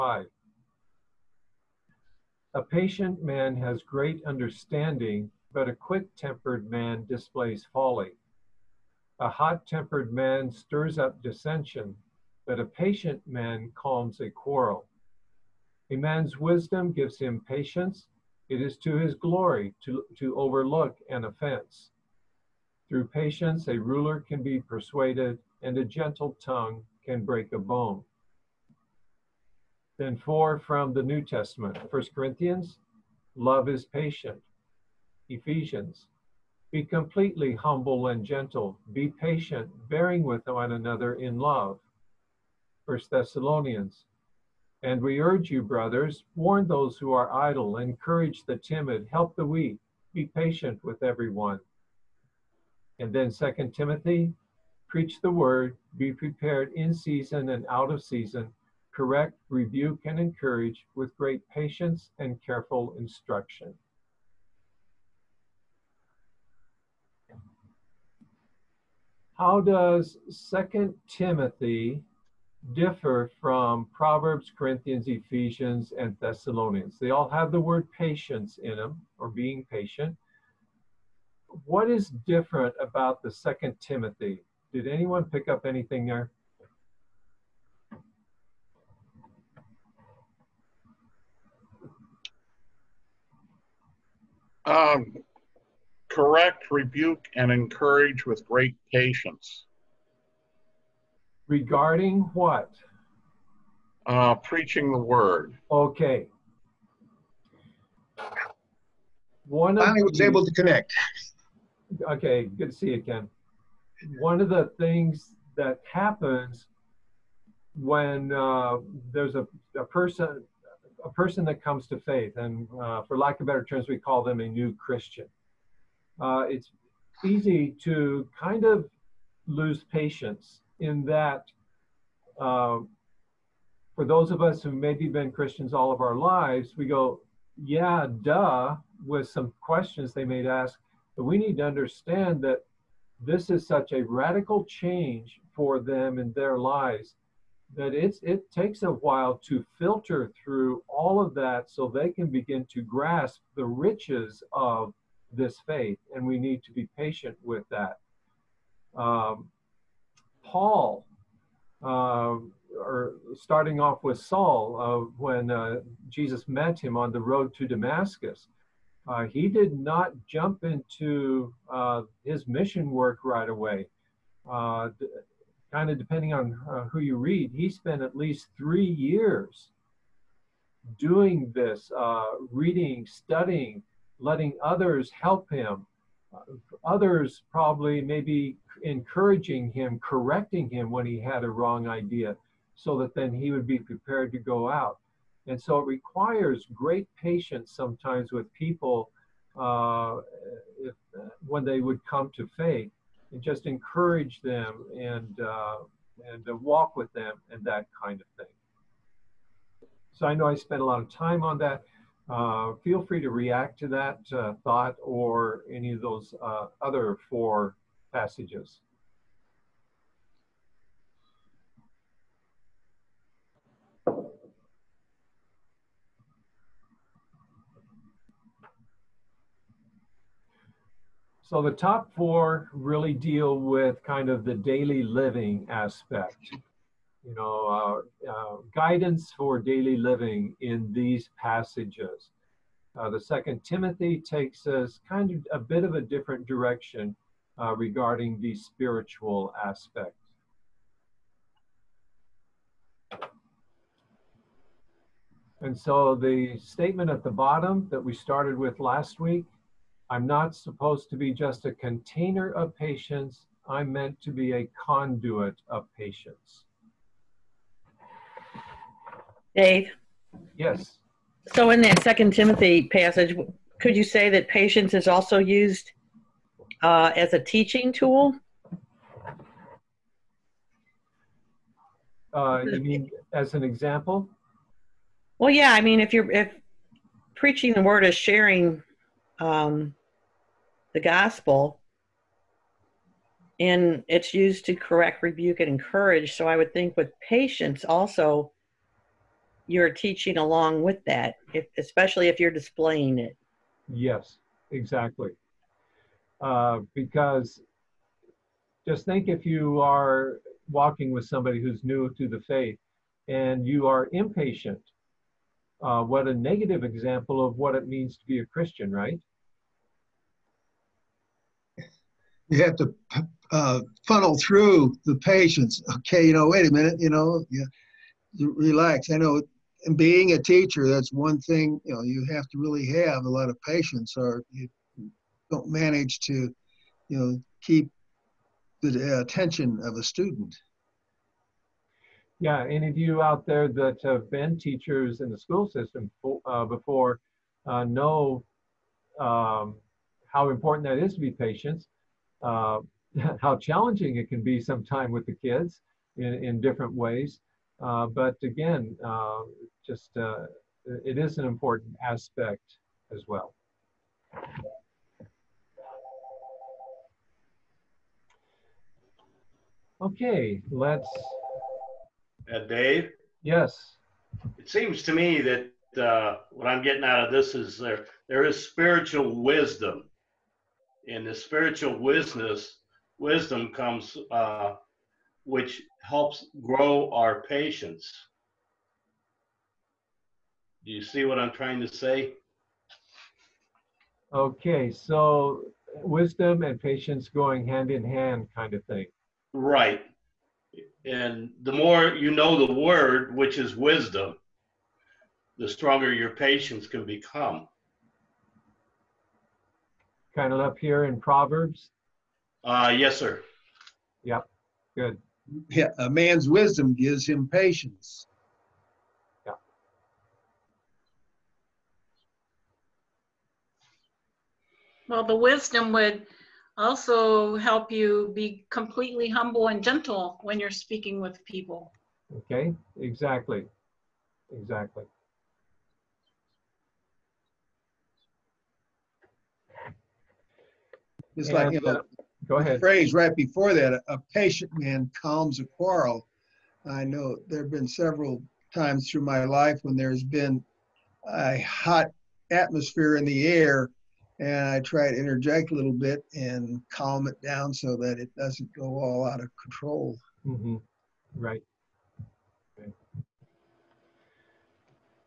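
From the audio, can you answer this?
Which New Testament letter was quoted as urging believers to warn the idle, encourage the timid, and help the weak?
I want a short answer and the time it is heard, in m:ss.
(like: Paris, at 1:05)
First Thessalonians, at 0:42.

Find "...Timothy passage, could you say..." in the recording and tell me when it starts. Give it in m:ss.
4:32.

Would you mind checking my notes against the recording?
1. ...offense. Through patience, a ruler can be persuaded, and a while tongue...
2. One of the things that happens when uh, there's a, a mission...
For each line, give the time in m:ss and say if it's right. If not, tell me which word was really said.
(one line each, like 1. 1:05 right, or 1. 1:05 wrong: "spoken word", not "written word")
1. 0:21 wrong: "gentle", not "while"
2. 1:54 wrong: "person", not "mission".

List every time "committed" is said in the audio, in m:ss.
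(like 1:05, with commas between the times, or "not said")
not said.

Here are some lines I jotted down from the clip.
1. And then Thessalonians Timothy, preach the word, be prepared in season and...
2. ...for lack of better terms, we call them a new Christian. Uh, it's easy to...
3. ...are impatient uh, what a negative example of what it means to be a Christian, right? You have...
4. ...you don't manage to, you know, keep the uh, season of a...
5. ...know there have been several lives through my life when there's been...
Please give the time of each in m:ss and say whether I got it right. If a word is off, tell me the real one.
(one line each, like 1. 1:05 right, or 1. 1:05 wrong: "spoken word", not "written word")
1. 0:52 wrong: "Second", not "Thessalonians"
2. 2:03 right
3. 5:13 right
4. 5:34 wrong: "attention", not "season"
5. 7:27 wrong: "times", not "lives".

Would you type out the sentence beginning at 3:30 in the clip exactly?
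So I know I spent a lot of time on that.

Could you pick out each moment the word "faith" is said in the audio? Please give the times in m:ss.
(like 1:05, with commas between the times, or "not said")
2:01, 2:35, 3:22, 5:12.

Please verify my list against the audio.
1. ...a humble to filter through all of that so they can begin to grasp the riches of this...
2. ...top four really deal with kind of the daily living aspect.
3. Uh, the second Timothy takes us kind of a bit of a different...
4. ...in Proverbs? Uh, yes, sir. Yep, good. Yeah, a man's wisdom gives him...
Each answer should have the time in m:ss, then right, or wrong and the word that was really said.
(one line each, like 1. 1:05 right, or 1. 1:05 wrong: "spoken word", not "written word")
1. 2:28 wrong: "while", not "humble"
2. 3:51 right
3. 4:02 right
4. 6:51 right.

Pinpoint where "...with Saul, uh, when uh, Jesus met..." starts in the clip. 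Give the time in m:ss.
2:44.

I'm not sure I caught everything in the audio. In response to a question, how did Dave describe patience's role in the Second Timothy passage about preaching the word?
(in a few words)
a teaching tool.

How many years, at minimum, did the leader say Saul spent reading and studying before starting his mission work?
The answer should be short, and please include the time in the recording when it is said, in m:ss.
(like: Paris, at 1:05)
3, at 2:58.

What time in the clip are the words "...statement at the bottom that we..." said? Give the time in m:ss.
4:16.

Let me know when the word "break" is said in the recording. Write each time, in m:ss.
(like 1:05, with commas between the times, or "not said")
0:27.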